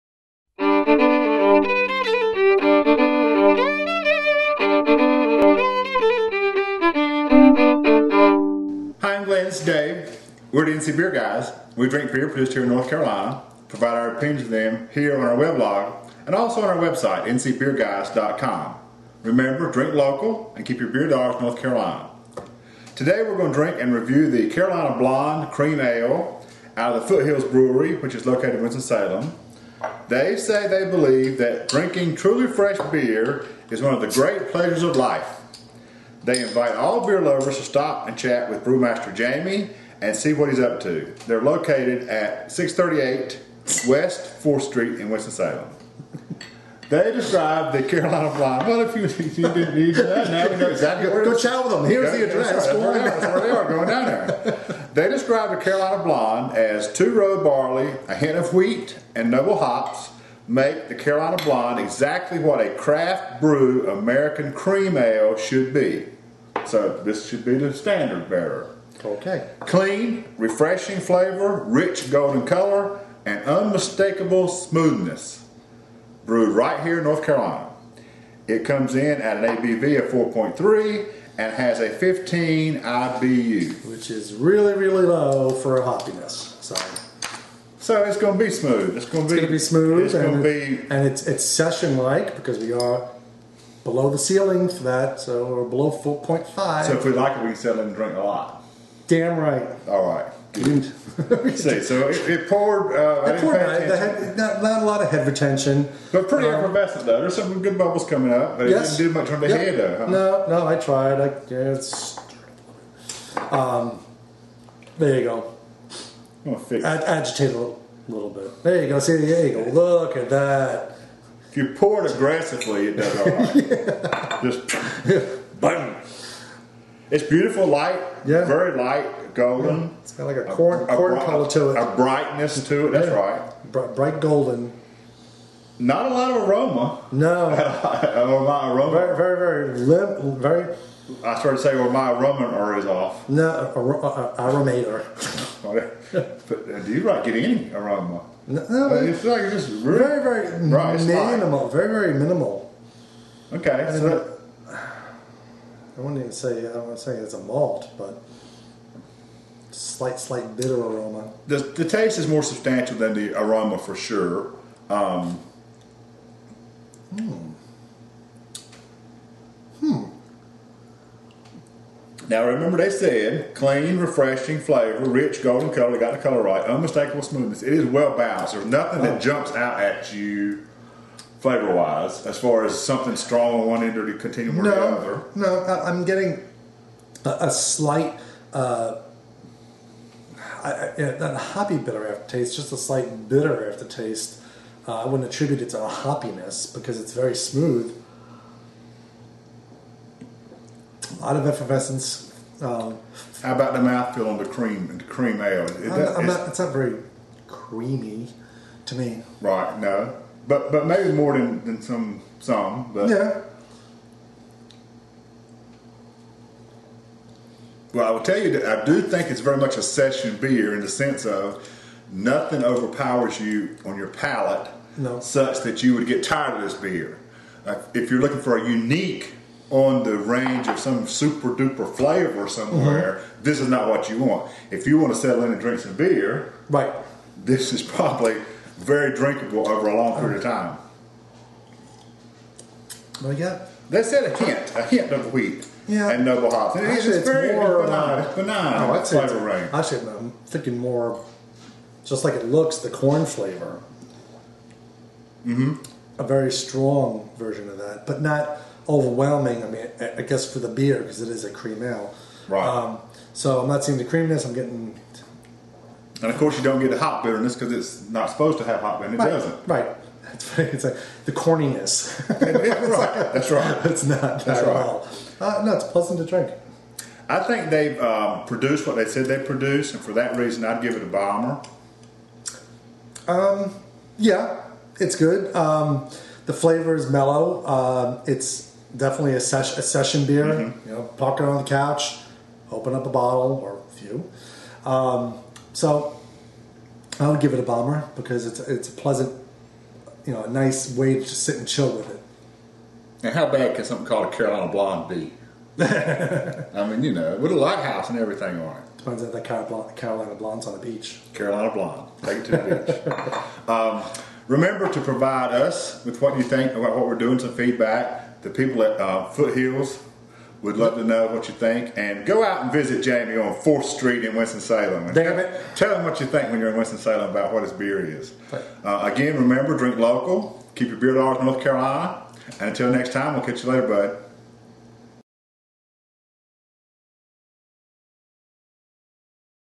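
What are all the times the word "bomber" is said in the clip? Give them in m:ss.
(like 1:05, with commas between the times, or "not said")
4:41, 4:57.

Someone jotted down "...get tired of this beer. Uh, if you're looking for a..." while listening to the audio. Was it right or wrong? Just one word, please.
right.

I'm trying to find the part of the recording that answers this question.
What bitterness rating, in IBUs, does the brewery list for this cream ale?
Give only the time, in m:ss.
1:21.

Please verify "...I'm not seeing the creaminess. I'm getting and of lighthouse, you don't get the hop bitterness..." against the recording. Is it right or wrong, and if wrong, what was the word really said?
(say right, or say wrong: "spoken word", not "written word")
wrong: "course", not "lighthouse".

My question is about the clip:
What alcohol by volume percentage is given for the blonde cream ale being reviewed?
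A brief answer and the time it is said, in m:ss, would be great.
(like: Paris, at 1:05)
4.3, at 1:20.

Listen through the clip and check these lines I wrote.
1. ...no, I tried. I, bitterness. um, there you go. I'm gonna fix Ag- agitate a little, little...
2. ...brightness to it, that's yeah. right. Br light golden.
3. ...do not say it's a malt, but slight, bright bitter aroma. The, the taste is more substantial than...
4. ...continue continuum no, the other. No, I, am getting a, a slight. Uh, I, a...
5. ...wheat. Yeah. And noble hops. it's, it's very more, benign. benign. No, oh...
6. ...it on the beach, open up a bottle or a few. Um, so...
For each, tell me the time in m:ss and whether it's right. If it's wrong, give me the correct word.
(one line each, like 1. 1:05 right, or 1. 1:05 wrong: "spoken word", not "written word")
1. 1:50 wrong: "guess", not "bitterness"
2. 2:11 wrong: "bright", not "light"
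3. 2:36 wrong: "slight", not "bright"
4. 3:04 right
5. 4:05 right
6. 4:51 wrong: "couch", not "beach".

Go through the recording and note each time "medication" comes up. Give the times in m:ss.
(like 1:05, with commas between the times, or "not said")
not said.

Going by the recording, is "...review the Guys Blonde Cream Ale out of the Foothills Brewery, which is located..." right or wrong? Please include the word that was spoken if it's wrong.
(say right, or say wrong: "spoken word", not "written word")
wrong: "Carolina", not "Guys".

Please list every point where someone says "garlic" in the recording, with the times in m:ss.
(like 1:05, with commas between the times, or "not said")
not said.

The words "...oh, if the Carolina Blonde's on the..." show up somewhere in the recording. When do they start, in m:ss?
5:09.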